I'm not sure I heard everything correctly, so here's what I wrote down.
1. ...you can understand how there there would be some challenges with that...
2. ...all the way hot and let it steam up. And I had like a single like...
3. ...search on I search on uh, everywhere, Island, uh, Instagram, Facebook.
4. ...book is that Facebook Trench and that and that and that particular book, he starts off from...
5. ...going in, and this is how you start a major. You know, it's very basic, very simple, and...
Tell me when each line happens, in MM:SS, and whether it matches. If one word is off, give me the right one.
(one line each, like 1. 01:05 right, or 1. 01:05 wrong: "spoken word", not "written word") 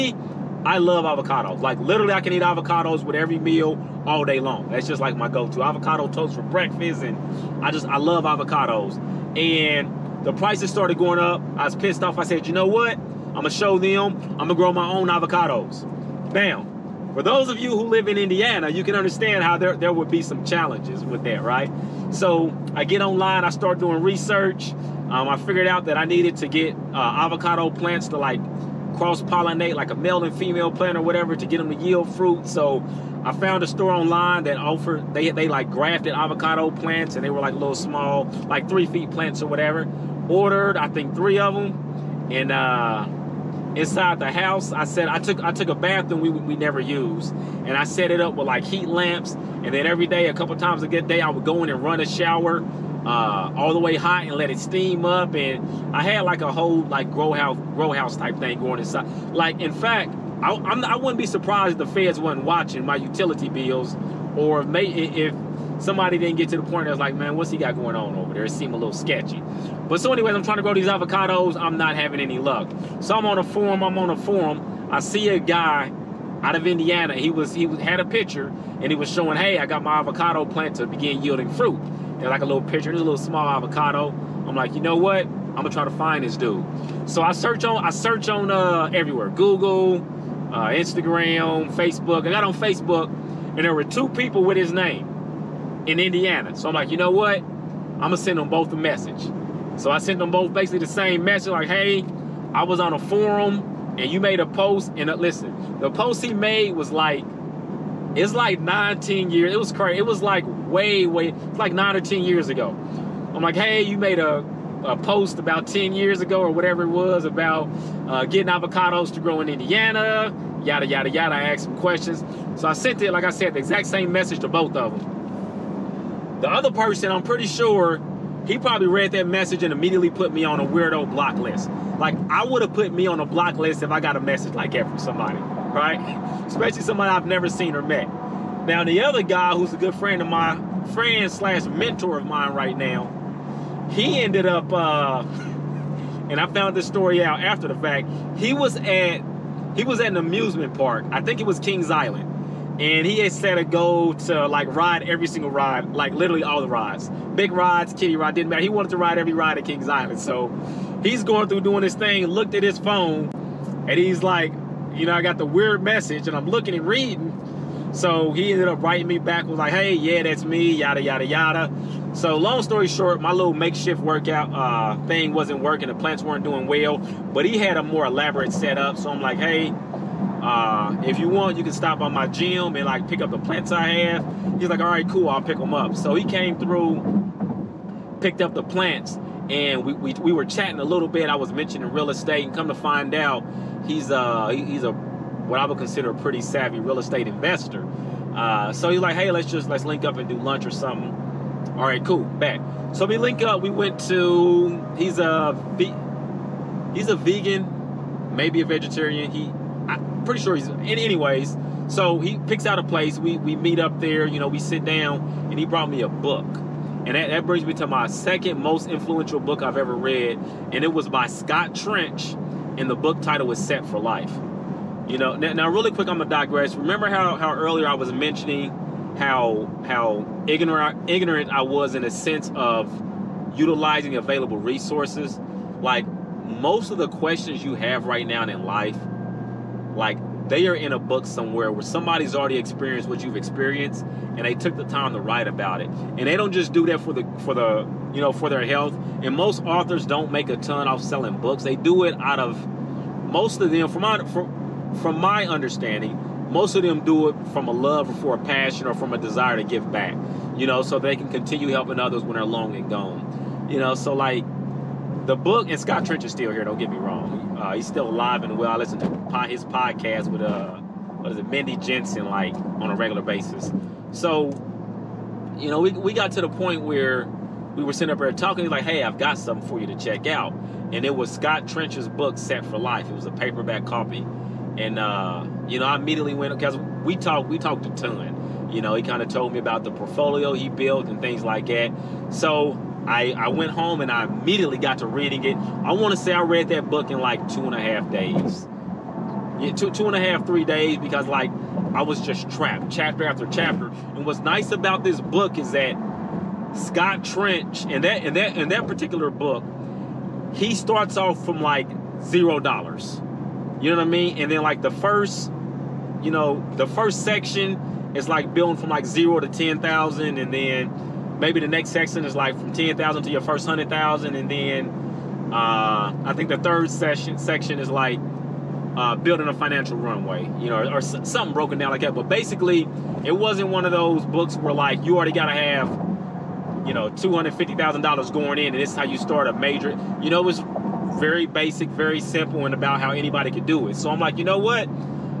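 1. 00:18 right
2. 00:53 wrong: "whole", not "single"
3. 01:27 wrong: "Google", not "Island"
4. 05:05 wrong: "Scott", not "Facebook"
5. 05:38 right.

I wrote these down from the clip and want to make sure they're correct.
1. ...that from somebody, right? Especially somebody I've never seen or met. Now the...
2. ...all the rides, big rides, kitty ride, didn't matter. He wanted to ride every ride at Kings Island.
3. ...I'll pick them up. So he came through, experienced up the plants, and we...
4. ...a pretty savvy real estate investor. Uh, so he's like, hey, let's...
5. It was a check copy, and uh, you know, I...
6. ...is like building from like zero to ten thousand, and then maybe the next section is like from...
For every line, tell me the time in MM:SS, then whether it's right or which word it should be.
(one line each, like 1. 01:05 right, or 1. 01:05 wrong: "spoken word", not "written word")
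1. 02:14 right
2. 02:36 right
3. 03:05 wrong: "picked", not "experienced"
4. 03:16 right
5. 04:43 wrong: "paperback", not "check"
6. 05:18 right.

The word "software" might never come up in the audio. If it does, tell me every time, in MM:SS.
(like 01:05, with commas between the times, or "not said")
not said.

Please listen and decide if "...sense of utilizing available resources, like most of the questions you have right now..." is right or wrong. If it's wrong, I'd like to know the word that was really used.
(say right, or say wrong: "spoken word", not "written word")
right.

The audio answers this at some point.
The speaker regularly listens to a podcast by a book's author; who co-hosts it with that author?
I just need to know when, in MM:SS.
04:31.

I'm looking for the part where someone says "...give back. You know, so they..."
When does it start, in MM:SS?
04:19.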